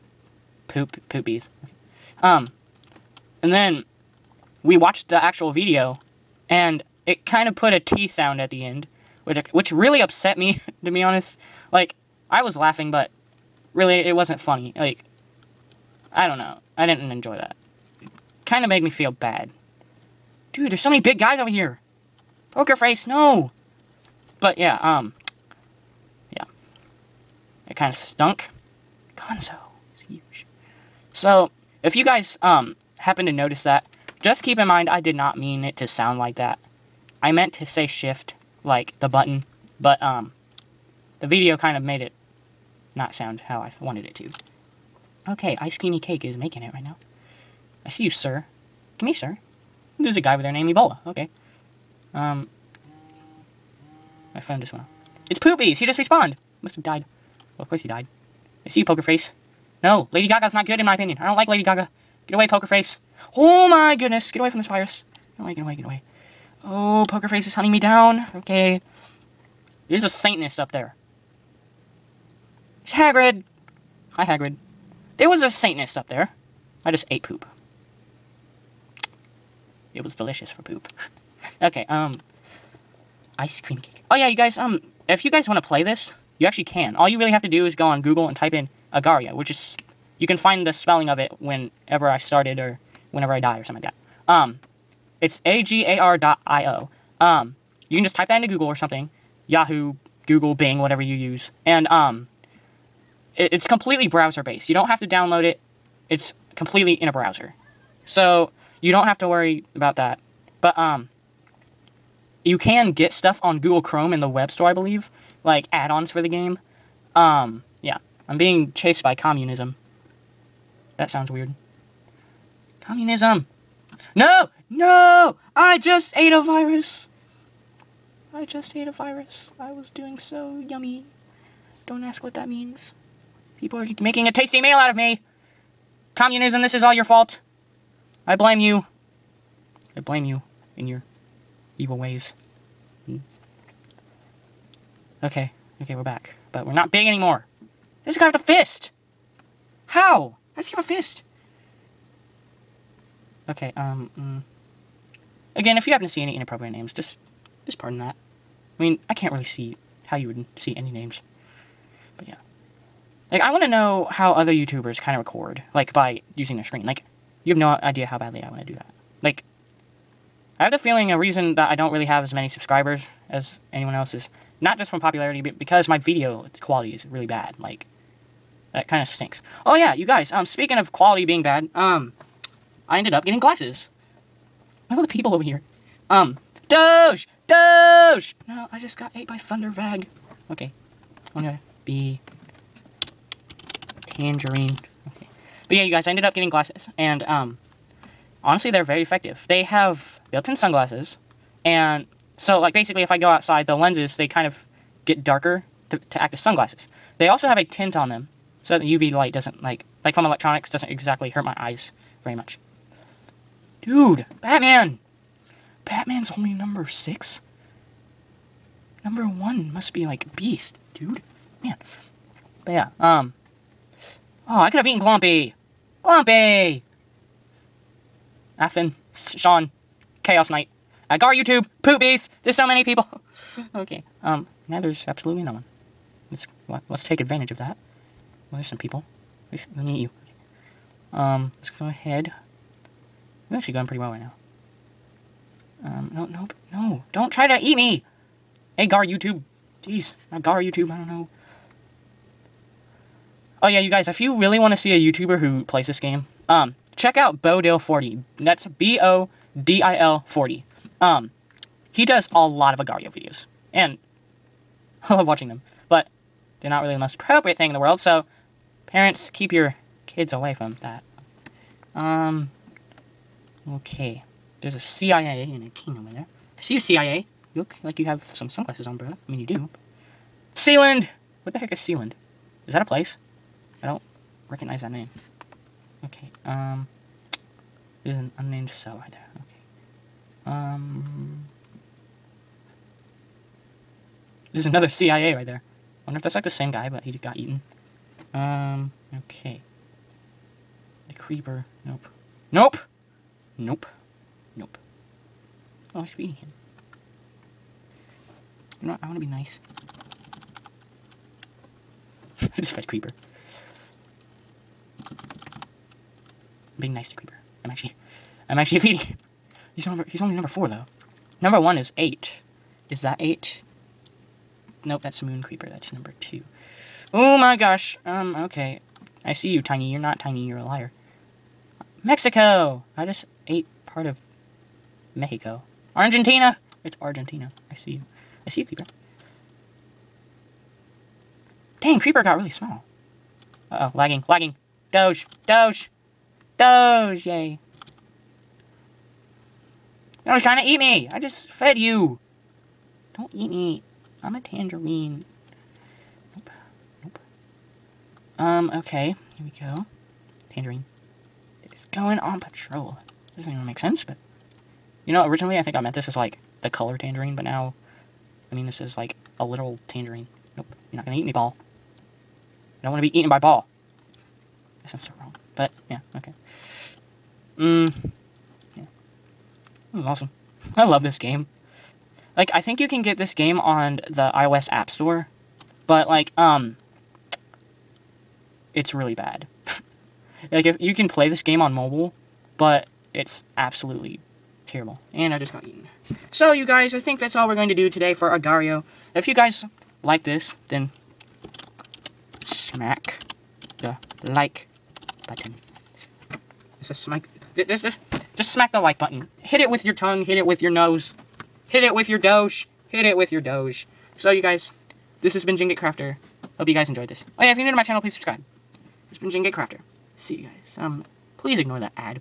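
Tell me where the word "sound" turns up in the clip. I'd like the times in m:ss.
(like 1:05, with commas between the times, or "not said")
0:08, 0:35, 0:43, 2:01, 6:14.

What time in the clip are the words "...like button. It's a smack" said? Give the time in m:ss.
6:44.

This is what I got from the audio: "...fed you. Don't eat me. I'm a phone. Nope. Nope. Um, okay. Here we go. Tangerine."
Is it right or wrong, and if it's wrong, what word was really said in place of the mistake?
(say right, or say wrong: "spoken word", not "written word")
wrong: "tangerine", not "phone".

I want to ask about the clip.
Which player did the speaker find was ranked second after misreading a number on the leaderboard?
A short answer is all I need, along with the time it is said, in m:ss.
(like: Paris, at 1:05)
Moon Creeper, at 5:25.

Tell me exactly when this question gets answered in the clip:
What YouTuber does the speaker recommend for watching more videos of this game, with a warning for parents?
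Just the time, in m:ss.
4:17.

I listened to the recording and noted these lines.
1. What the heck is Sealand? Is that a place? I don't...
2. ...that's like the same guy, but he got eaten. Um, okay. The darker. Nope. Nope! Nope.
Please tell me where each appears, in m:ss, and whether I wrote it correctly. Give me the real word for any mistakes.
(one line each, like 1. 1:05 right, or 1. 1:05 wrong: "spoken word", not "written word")
1. 4:41 right
2. 4:56 wrong: "creeper", not "darker".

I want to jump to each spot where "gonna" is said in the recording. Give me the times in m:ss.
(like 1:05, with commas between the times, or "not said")
3:11, 6:11.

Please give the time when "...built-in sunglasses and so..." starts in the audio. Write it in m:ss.
3:20.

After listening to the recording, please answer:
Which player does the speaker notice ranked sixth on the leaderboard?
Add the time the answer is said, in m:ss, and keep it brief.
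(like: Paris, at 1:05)
Batman, at 3:35.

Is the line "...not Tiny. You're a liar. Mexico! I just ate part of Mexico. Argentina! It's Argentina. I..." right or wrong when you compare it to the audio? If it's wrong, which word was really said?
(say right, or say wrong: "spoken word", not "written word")
right.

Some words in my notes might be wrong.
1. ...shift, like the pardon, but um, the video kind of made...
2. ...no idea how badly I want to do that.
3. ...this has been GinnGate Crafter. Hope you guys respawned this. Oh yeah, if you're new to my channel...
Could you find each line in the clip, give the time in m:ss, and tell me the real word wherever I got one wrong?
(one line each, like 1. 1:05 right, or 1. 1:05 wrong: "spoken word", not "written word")
1. 0:37 wrong: "button", not "pardon"
2. 2:47 right
3. 6:55 wrong: "enjoyed", not "respawned".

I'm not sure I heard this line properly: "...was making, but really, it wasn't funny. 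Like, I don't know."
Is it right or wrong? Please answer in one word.
wrong.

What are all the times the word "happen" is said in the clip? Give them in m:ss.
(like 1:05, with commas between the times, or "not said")
0:32, 2:35.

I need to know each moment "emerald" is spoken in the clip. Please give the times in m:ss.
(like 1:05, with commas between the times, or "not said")
not said.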